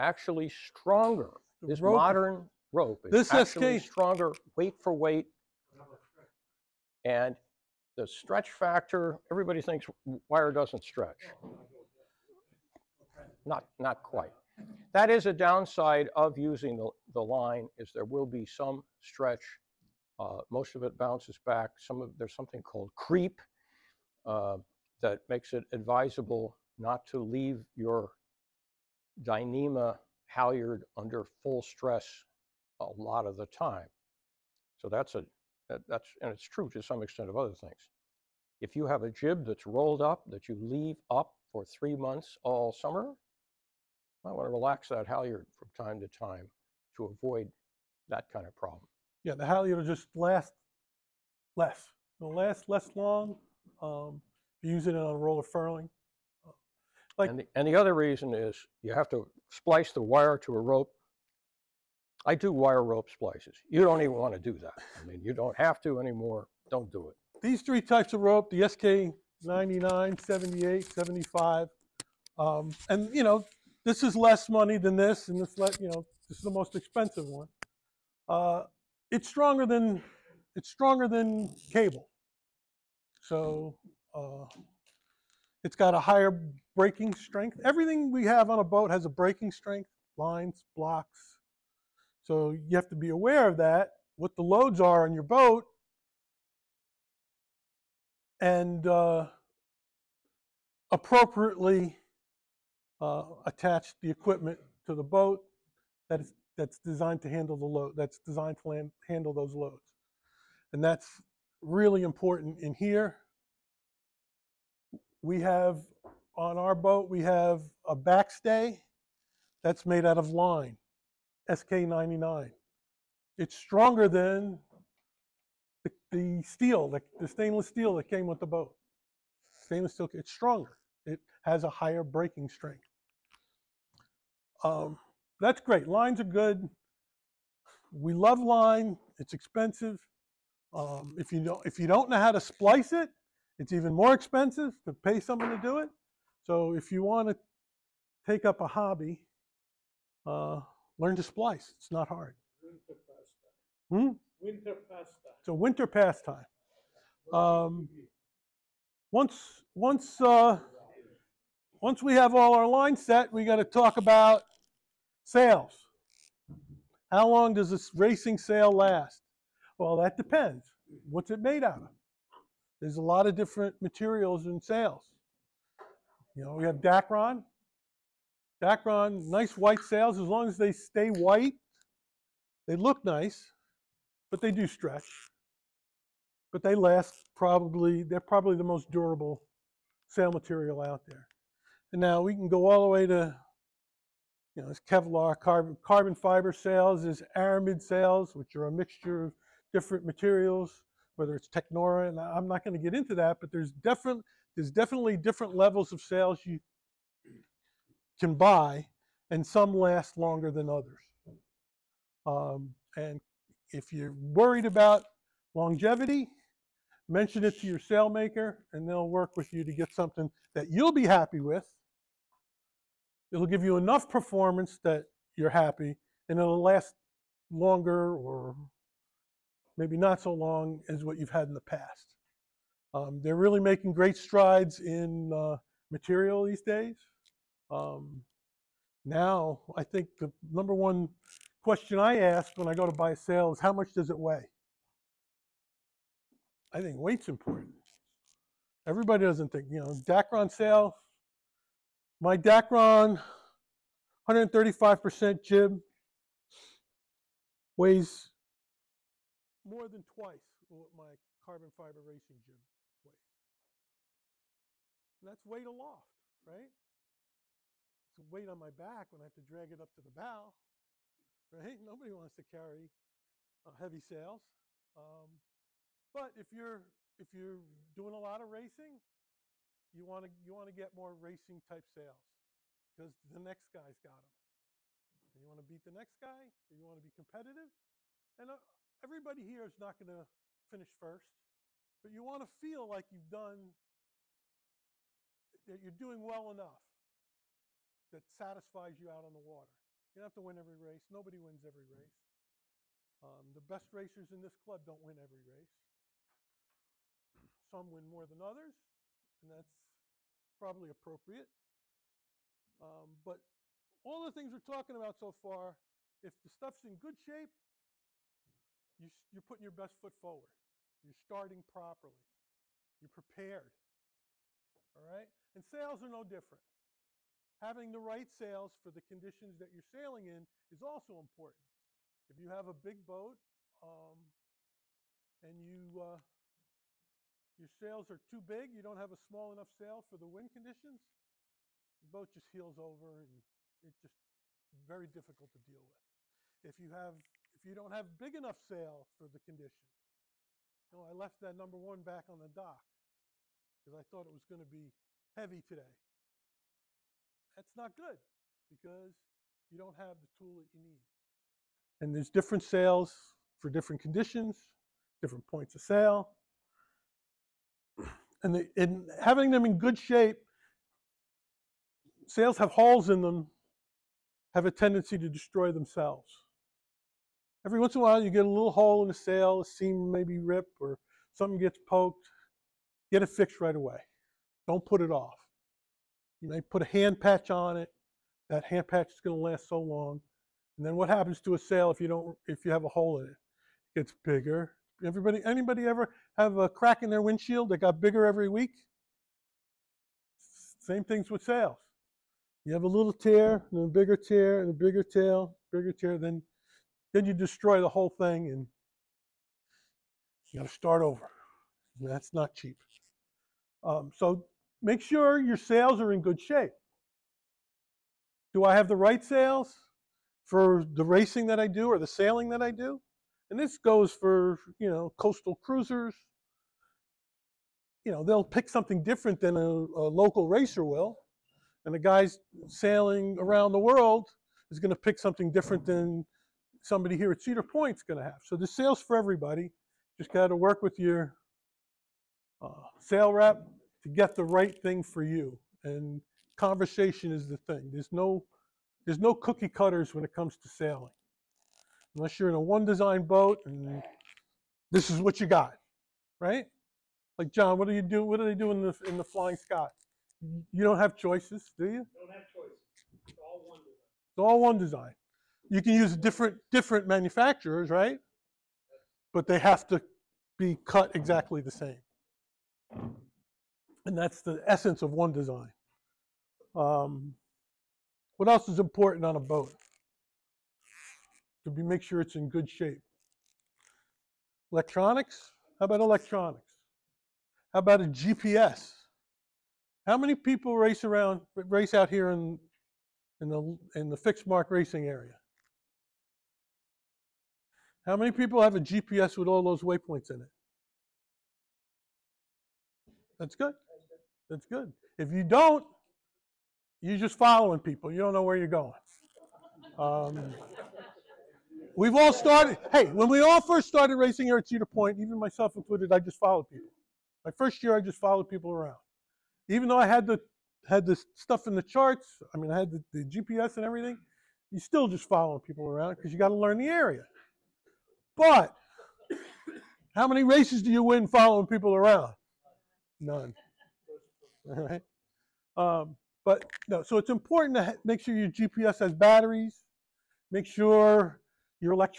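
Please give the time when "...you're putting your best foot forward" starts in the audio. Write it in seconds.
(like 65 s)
319 s.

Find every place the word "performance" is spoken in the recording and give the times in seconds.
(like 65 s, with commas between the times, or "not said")
224 s.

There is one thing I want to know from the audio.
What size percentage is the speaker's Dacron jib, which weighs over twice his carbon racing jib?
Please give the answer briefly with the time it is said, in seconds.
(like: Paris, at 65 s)
135%, at 254 s.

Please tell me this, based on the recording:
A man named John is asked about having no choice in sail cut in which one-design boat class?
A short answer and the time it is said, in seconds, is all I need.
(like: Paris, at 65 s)
Flying Scot, at 459 s.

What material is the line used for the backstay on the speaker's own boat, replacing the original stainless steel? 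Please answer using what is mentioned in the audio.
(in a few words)
SK99.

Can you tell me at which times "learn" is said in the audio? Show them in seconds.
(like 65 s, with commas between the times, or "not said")
150 s, 526 s.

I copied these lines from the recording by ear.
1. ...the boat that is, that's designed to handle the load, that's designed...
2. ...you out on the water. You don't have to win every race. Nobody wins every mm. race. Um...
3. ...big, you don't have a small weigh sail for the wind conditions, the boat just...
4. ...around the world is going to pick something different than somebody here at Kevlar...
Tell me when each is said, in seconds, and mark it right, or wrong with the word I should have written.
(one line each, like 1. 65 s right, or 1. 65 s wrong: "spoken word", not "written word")
1. 104 s right
2. 298 s right
3. 338 s wrong: "enough", not "weigh"
4. 433 s wrong: "Cedar", not "Kevlar".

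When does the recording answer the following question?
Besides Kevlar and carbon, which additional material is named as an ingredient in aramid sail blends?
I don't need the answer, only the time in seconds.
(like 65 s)
201 s.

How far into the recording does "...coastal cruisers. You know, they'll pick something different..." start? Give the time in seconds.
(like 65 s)
425 s.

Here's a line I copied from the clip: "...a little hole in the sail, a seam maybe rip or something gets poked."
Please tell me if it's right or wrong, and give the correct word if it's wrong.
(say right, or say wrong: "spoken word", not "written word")
right.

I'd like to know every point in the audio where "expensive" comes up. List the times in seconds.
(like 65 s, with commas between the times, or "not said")
76 s, 139 s, 144 s.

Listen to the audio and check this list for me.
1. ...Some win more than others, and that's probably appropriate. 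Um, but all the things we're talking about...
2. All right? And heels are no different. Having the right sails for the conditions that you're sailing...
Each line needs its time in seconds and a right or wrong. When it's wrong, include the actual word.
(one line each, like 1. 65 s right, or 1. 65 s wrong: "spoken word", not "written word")
1. 307 s right
2. 324 s wrong: "sails", not "heels".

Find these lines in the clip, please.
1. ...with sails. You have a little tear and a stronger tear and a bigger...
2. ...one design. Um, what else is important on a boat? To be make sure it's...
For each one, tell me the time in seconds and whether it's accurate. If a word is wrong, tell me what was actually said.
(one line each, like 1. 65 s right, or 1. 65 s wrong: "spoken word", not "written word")
1. 401 s wrong: "bigger", not "stronger"
2. 475 s right.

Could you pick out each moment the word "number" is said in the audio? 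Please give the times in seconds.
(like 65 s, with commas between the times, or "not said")
240 s, 351 s.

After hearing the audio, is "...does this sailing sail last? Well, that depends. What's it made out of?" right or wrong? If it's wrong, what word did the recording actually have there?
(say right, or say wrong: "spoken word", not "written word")
wrong: "racing", not "sailing".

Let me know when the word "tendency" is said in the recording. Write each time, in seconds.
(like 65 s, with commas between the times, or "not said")
374 s.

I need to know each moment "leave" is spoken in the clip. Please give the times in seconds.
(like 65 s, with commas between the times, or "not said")
27 s, 40 s.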